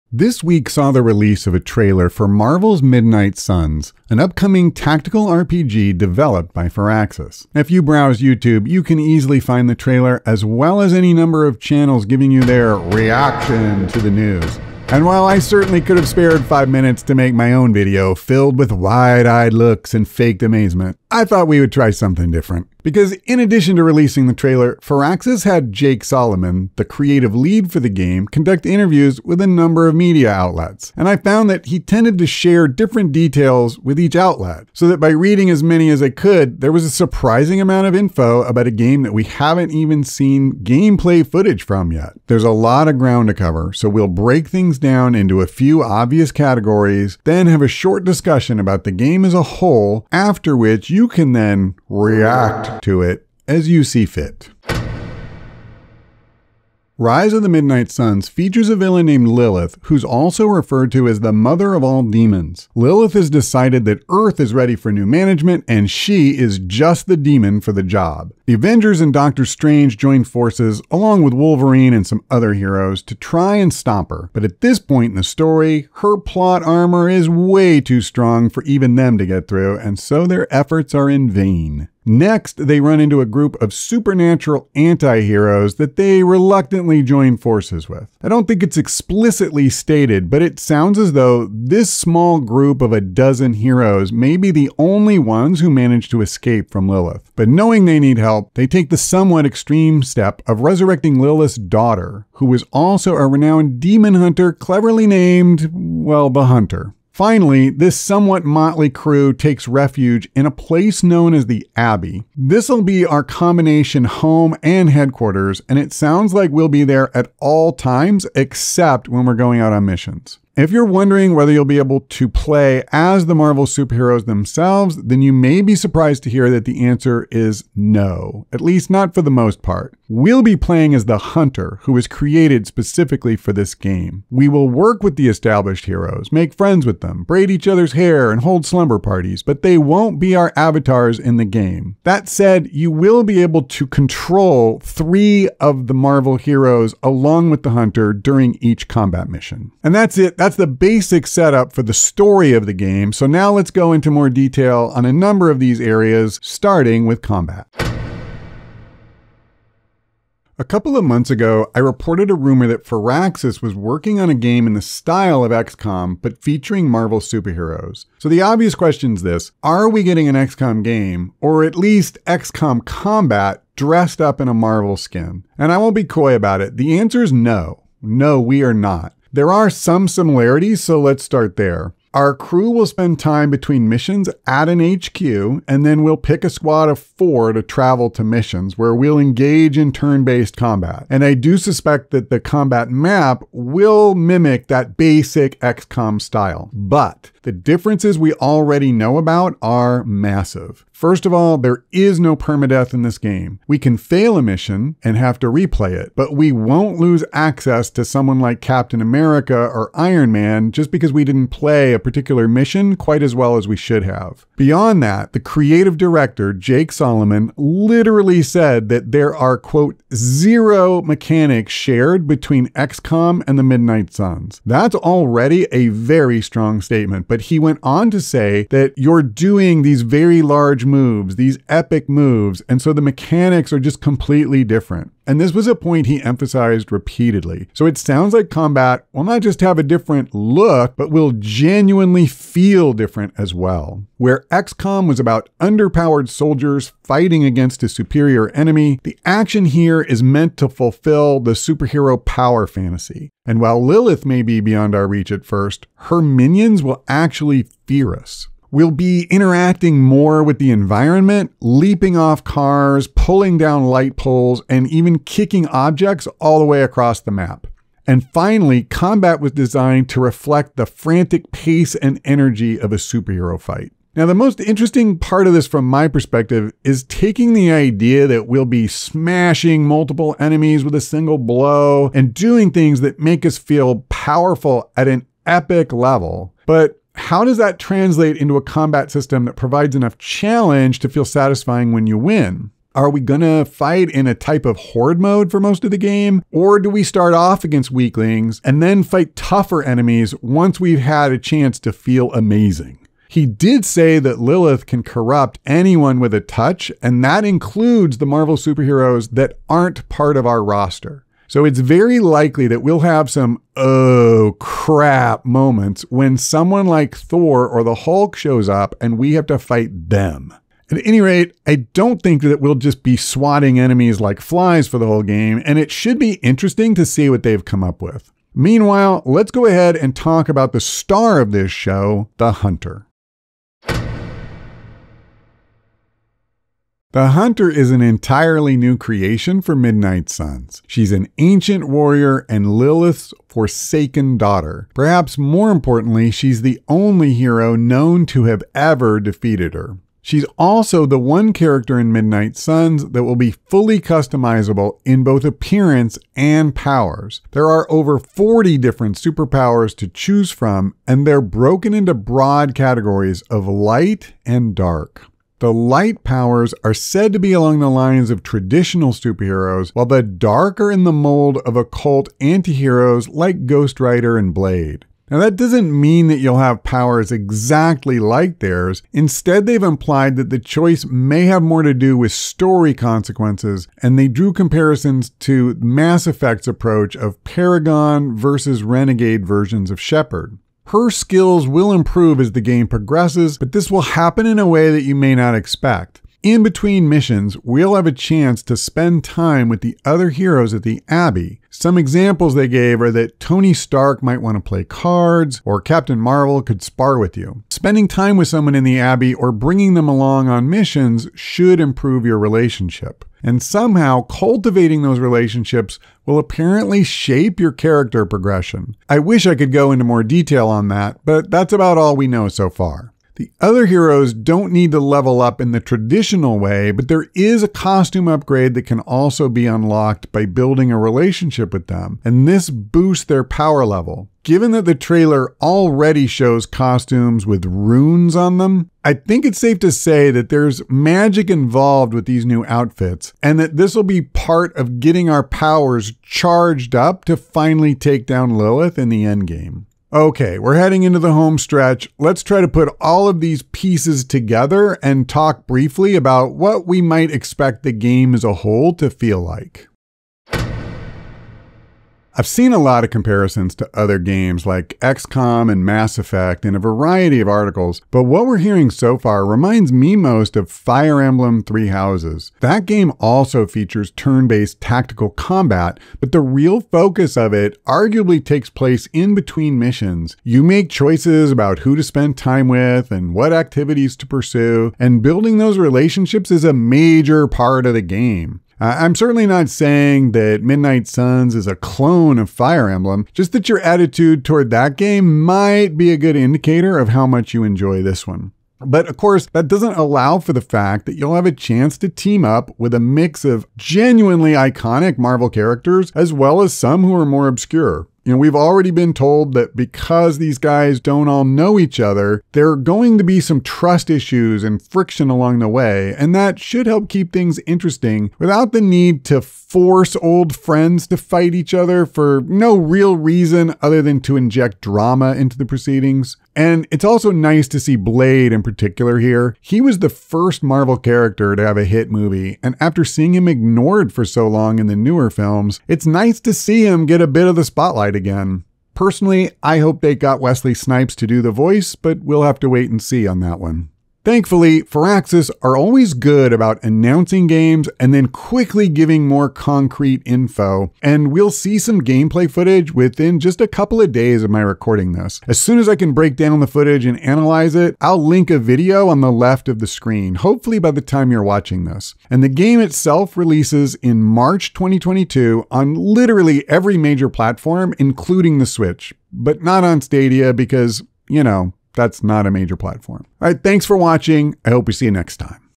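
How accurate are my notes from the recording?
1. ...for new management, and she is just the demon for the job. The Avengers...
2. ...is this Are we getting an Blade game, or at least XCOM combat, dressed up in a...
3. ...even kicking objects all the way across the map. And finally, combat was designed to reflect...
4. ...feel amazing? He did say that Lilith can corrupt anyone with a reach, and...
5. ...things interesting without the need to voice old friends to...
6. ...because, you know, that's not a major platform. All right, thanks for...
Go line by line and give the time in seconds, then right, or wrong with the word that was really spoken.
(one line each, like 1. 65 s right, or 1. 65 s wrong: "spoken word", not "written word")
1. 64 s right
2. 169 s wrong: "XCOM", not "Blade"
3. 264 s right
4. 301 s wrong: "touch", not "reach"
5. 517 s wrong: "force", not "voice"
6. 570 s right.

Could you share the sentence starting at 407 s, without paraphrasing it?
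Spending time with someone in the Abbey or bringing them along on missions should improve your relationship.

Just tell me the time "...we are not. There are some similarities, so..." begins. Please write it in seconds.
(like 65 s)
178 s.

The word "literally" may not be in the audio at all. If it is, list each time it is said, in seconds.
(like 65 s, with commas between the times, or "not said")
217 s, 565 s.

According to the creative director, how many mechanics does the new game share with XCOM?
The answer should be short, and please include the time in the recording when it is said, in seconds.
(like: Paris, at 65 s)
zero, at 220 s.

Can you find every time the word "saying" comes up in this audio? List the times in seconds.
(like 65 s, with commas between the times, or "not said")
489 s.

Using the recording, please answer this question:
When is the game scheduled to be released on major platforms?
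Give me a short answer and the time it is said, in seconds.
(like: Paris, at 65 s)
March 2022, at 564 s.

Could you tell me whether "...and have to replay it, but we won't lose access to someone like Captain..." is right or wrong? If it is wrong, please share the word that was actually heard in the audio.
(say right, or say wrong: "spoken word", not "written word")
right.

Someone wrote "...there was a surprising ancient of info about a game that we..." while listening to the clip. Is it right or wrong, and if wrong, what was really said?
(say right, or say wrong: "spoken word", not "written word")
wrong: "amount", not "ancient".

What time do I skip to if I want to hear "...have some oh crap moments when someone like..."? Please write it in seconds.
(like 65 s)
313 s.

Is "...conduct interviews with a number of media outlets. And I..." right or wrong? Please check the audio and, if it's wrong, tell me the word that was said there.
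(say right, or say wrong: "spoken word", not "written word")
right.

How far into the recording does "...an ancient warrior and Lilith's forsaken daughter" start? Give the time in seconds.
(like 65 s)
341 s.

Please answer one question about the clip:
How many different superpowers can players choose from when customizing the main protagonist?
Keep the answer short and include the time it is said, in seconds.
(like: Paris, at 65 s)
over 40, at 357 s.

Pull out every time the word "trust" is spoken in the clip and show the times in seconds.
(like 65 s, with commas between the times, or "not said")
513 s.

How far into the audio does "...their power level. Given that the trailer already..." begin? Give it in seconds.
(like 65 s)
433 s.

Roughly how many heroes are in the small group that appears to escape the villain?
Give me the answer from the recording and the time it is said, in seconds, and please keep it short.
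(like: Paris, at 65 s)
a dozen, at 92 s.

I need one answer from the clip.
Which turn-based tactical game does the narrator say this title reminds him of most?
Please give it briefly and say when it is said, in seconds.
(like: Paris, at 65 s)
Fire Emblem Three Houses, at 470 s.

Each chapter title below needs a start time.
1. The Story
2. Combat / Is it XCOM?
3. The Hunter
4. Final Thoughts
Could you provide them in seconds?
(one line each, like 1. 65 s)
1. 55 s
2. 158 s
3. 333 s
4. 460 s.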